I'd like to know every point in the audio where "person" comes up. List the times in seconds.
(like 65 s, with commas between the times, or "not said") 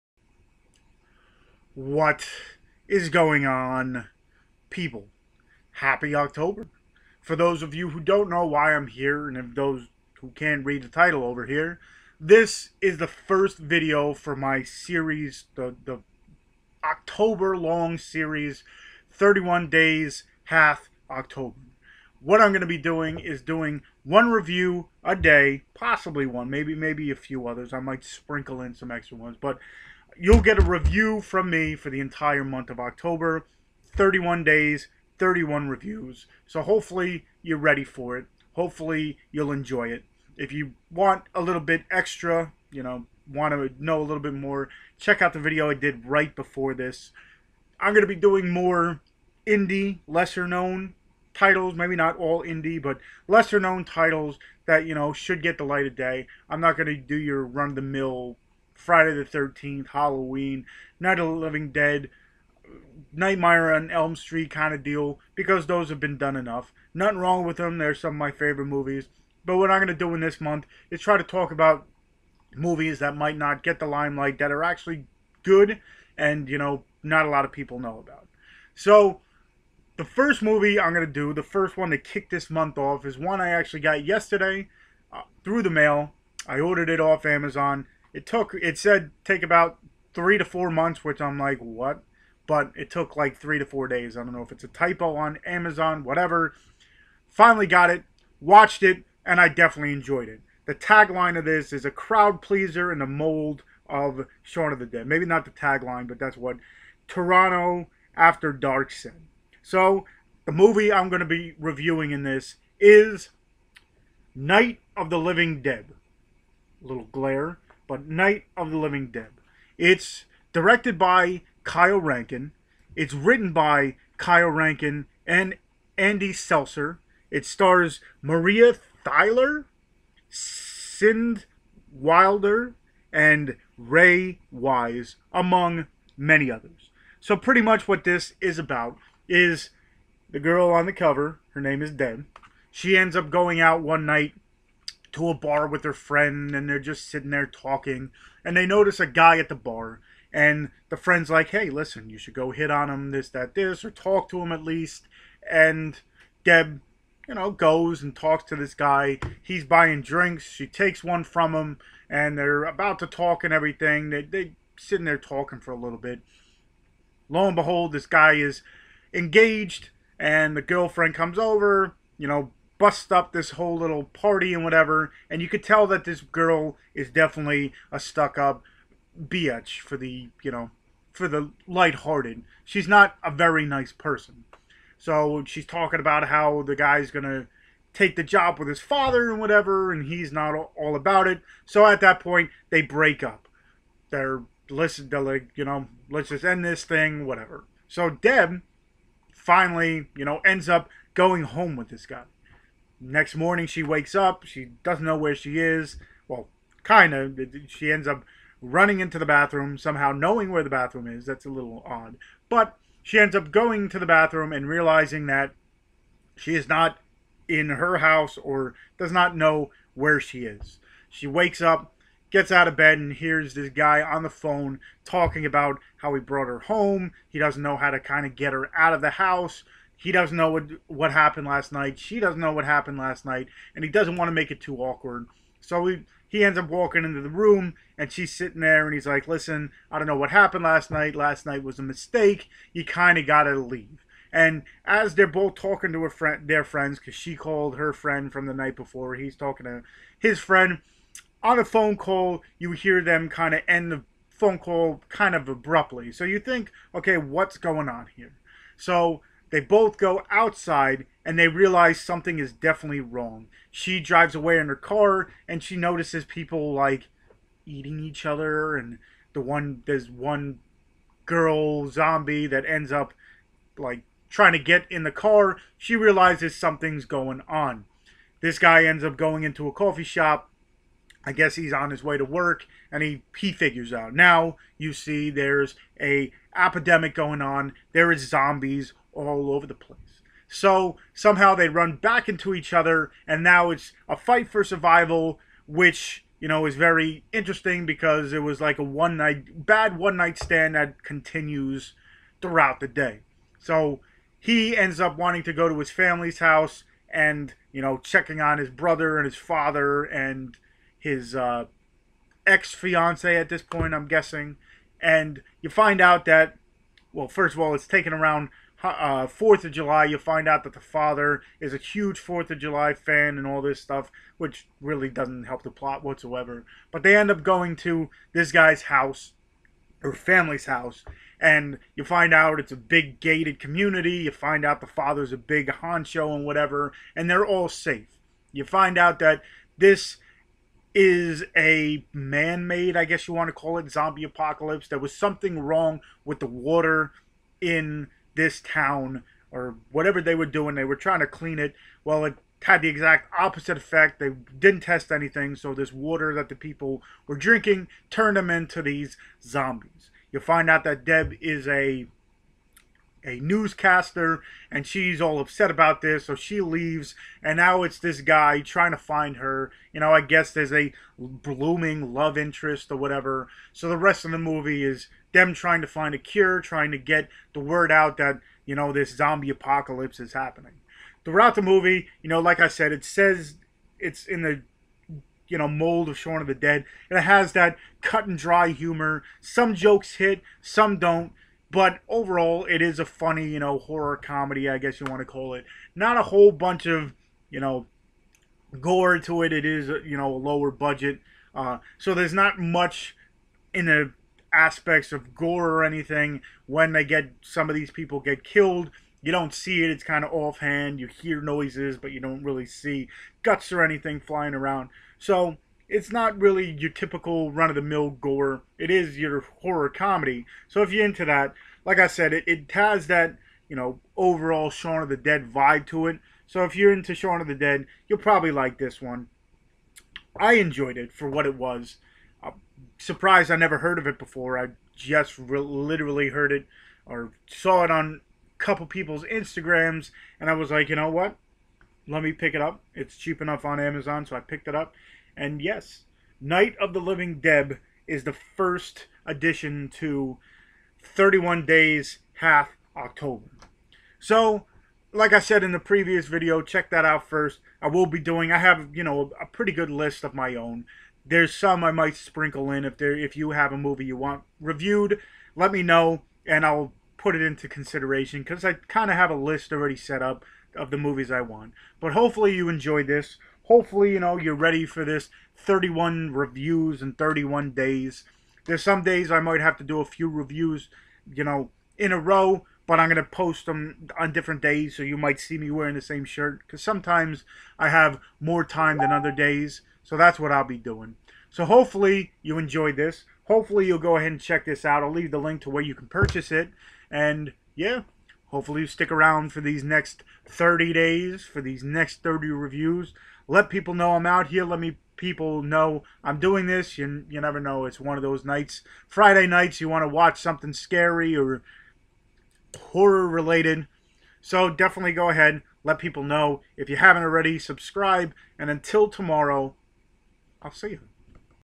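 183 s.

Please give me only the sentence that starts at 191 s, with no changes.
So at that point, they break up.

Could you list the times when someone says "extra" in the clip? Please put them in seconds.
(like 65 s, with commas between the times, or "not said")
28 s, 41 s.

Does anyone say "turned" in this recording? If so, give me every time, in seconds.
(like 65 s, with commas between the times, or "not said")
358 s.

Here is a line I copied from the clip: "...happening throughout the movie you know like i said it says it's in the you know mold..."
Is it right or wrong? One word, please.
right.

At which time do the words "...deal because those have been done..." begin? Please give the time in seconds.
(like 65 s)
64 s.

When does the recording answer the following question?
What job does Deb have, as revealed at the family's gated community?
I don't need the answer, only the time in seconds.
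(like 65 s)
363 s.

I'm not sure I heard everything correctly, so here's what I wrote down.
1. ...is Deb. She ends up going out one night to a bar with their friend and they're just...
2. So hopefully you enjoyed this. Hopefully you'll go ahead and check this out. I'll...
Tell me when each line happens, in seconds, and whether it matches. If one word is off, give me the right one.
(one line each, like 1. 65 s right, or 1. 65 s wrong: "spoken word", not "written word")
1. 141 s right
2. 491 s right.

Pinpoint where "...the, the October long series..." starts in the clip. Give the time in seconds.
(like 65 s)
15 s.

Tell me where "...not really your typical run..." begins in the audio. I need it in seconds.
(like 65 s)
416 s.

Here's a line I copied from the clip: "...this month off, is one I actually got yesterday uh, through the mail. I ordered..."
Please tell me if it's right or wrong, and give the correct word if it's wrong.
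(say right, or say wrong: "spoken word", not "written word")
right.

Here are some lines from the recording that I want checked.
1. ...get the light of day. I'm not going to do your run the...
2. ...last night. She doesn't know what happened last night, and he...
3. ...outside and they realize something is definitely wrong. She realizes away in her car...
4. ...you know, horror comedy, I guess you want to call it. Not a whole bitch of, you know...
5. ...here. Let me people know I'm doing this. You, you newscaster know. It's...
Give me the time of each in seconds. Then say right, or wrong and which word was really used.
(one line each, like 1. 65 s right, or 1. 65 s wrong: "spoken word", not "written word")
1. 55 s right
2. 231 s right
3. 260 s wrong: "drives", not "realizes"
4. 393 s wrong: "bunch", not "bitch"
5. 504 s wrong: "never", not "newscaster".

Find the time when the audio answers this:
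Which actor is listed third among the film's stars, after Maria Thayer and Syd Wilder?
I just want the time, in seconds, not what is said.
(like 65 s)
133 s.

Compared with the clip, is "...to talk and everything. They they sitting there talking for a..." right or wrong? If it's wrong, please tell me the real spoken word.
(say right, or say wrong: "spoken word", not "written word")
right.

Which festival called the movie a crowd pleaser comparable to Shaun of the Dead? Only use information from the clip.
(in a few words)
Toronto After Dark.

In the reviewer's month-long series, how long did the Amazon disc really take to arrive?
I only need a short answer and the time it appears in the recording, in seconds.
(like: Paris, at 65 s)
3 to 4 days, at 93 s.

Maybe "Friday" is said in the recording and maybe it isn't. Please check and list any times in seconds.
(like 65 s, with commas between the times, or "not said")
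58 s, 509 s.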